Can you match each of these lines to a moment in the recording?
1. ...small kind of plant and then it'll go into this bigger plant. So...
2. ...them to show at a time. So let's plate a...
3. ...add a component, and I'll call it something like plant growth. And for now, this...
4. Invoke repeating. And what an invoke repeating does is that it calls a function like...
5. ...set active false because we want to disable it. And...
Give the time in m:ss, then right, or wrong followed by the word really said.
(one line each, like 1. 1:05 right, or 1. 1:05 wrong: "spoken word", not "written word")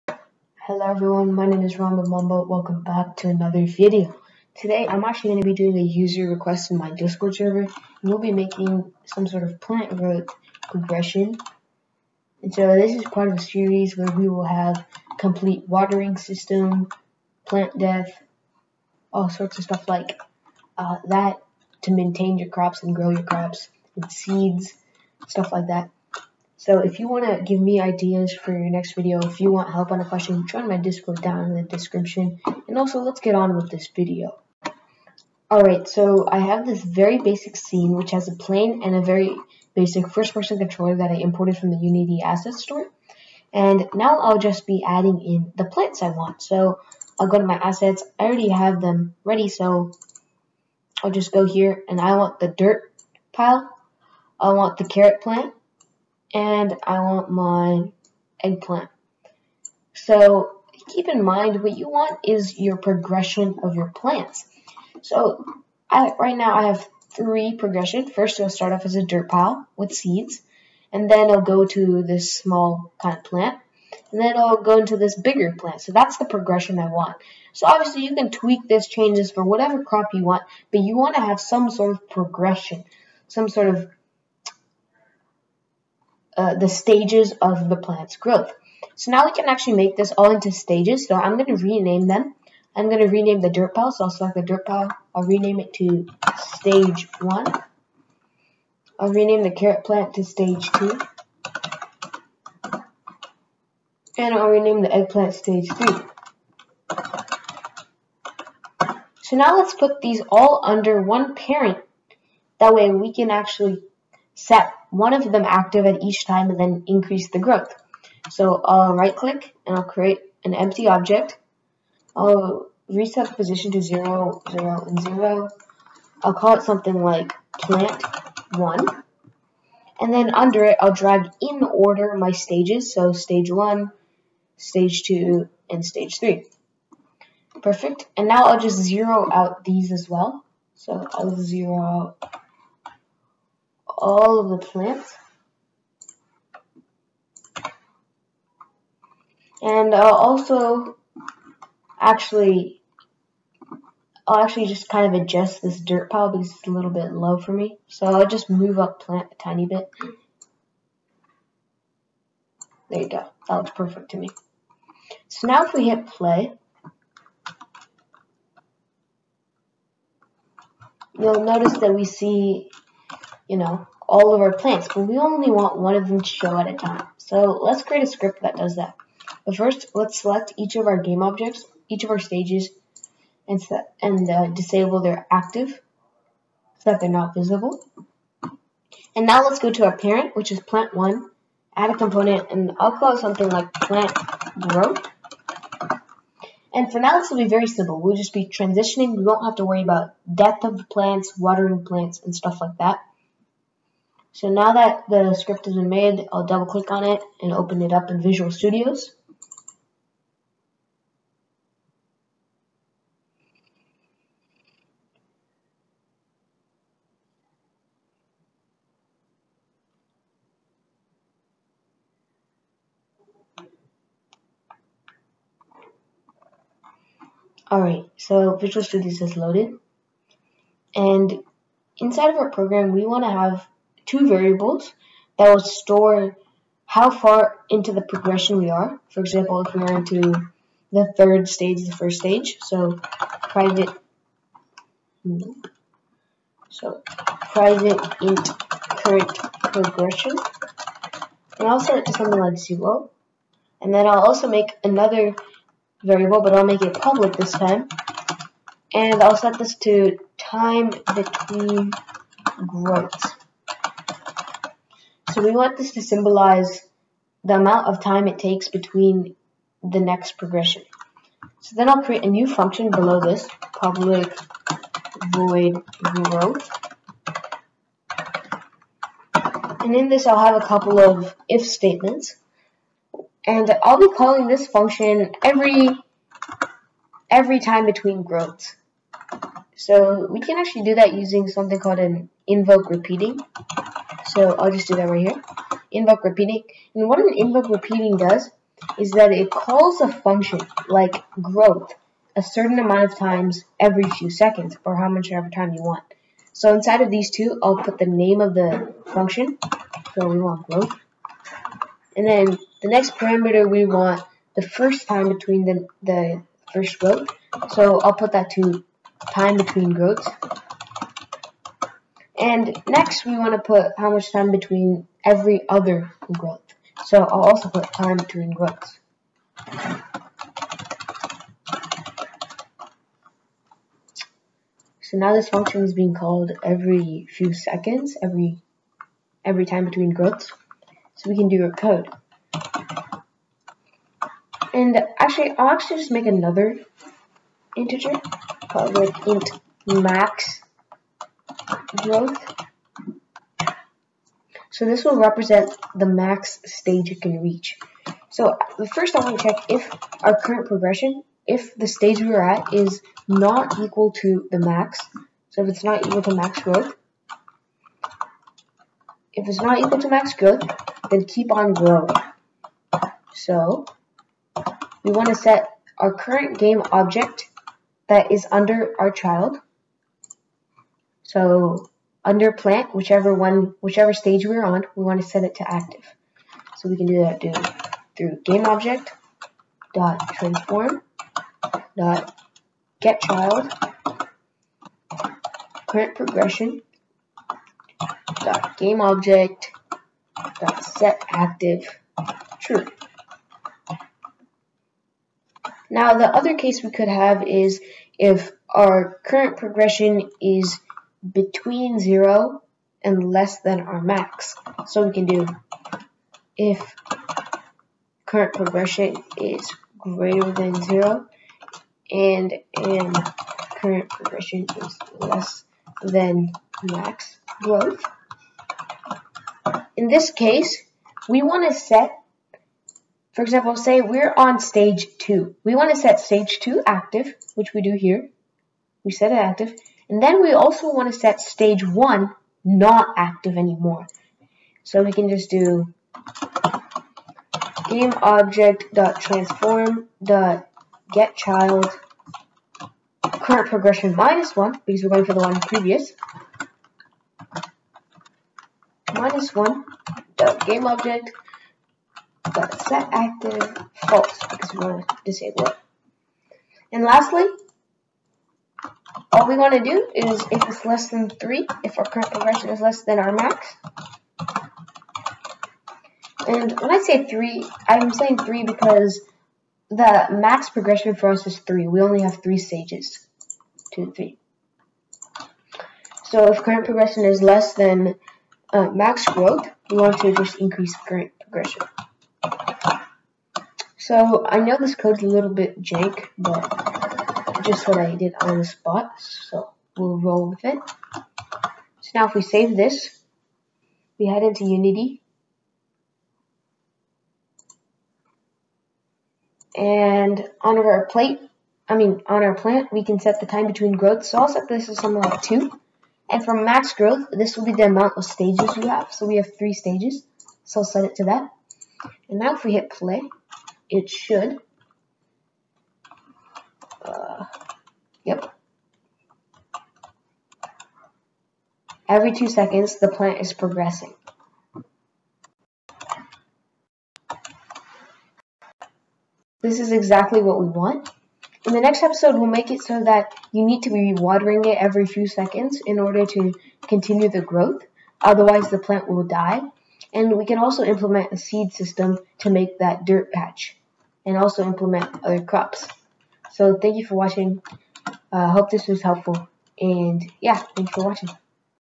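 1. 1:12 right
2. 2:56 wrong: "create", not "plate"
3. 3:11 right
4. 4:55 right
5. 7:42 right.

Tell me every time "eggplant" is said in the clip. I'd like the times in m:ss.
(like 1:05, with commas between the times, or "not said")
0:58, 1:44.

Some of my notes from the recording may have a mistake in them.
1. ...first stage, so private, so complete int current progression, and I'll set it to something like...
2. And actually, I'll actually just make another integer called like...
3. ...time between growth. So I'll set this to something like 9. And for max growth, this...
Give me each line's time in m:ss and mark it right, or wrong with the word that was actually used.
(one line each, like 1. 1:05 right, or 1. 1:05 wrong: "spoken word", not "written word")
1. 4:01 wrong: "private", not "complete"
2. 5:44 right
3. 8:33 wrong: "2", not "9".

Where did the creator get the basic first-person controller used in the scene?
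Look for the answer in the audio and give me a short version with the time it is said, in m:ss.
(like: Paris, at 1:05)
Unity Asset Store, at 0:41.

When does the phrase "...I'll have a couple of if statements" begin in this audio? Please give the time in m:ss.
4:40.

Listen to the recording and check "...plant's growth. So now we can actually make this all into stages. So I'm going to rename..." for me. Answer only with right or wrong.
right.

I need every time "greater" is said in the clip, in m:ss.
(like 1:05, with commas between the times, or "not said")
6:59.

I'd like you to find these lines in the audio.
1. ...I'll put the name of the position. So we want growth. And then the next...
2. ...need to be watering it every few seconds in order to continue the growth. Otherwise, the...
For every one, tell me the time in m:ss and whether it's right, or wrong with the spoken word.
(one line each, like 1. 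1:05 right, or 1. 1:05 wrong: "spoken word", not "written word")
1. 5:07 wrong: "function", not "position"
2. 9:03 right.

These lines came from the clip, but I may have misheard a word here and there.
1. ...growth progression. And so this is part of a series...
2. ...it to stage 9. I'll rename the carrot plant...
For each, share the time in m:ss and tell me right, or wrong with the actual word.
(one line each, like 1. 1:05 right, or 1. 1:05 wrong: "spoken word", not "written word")
1. 0:09 right
2. 1:35 wrong: "1", not "9".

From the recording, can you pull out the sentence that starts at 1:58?
So I'll right click and I'll create an empty object.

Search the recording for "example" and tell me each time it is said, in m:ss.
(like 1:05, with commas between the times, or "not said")
3:59, 7:13.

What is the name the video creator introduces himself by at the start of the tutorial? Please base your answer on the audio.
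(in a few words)
Ramba Mamba.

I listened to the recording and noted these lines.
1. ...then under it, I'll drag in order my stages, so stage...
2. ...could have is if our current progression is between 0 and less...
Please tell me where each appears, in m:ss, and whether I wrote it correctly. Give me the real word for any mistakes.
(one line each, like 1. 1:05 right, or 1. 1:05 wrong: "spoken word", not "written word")
1. 2:10 right
2. 6:46 right.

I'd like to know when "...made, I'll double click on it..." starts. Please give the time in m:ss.
3:25.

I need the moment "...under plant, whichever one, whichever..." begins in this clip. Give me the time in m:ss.
6:22.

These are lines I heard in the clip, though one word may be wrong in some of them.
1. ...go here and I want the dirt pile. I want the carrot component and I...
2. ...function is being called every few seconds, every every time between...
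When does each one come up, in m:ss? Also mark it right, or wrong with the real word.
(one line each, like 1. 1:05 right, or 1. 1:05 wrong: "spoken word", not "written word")
1. 0:51 wrong: "plant", not "component"
2. 5:35 right.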